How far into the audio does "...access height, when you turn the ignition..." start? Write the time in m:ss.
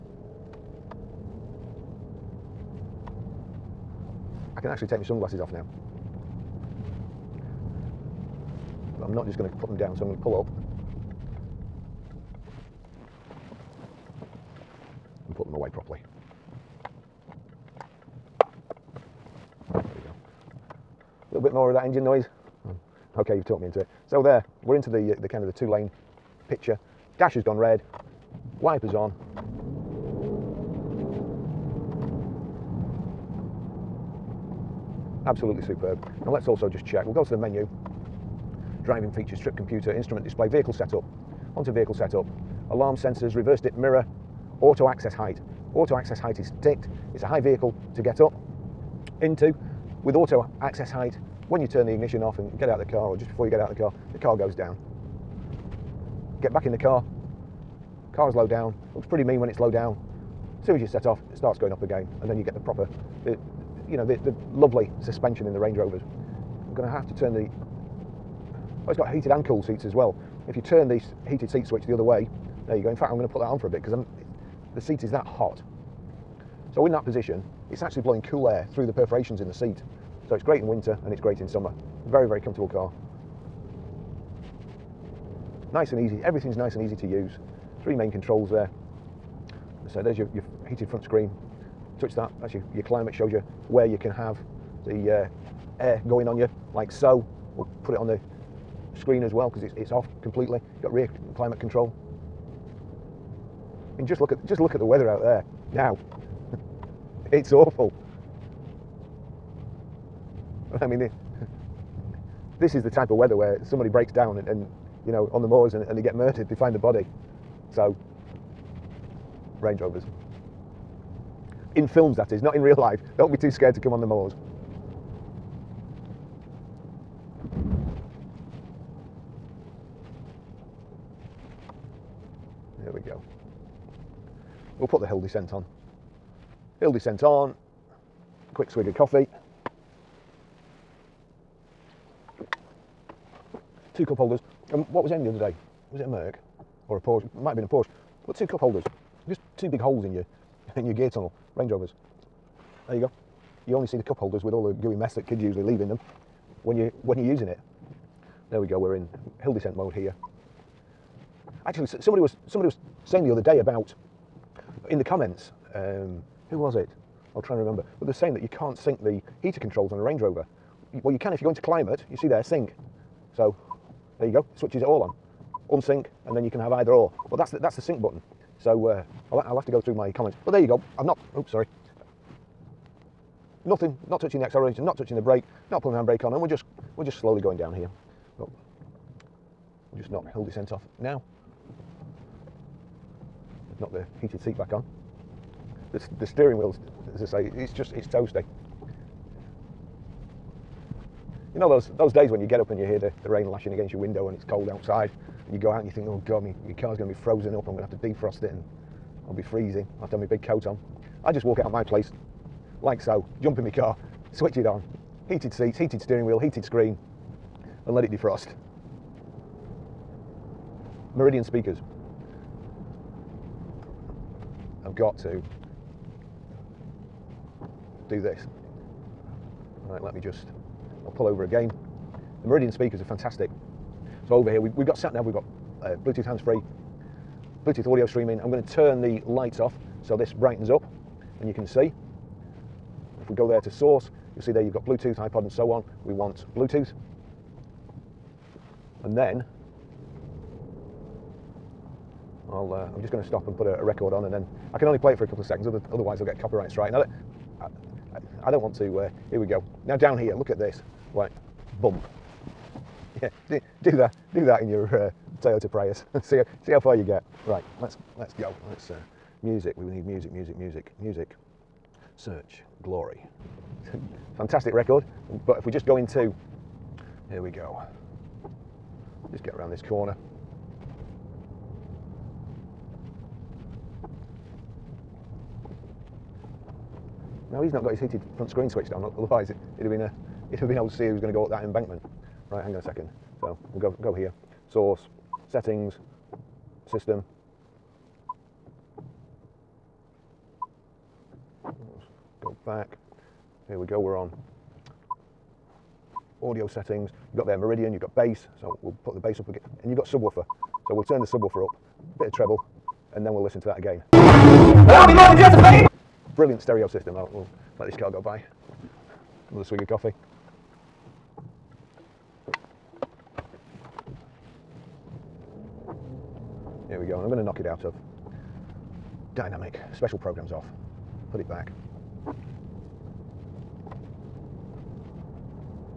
0:50.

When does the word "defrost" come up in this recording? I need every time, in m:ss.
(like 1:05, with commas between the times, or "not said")
3:27, 3:38.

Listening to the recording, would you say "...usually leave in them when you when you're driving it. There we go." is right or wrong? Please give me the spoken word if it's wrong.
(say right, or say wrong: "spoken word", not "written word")
wrong: "using", not "driving".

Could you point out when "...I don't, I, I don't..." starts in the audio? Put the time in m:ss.
4:16.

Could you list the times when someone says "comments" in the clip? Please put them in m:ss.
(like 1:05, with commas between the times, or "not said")
2:45, 3:00.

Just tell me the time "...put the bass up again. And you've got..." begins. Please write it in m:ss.
5:09.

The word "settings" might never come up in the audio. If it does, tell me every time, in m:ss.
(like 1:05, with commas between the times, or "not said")
4:55, 5:06.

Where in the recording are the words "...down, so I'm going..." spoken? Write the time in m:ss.
0:09.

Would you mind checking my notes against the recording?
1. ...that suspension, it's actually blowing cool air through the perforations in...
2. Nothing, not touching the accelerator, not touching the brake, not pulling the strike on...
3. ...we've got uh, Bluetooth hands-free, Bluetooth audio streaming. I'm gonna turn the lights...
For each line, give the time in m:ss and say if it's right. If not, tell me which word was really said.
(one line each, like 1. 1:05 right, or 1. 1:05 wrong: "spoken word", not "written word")
1. 1:16 wrong: "position", not "suspension"
2. 3:03 wrong: "handbrake", not "strike"
3. 3:55 right.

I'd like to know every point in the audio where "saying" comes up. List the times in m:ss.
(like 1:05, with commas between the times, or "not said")
2:43, 2:48.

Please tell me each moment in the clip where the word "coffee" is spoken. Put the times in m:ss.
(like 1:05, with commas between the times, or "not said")
2:18, 5:19.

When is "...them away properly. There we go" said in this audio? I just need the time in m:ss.
0:15.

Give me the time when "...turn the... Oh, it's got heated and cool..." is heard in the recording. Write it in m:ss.
1:07.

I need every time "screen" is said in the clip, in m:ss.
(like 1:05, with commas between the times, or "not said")
1:31, 1:38, 3:36, 4:48.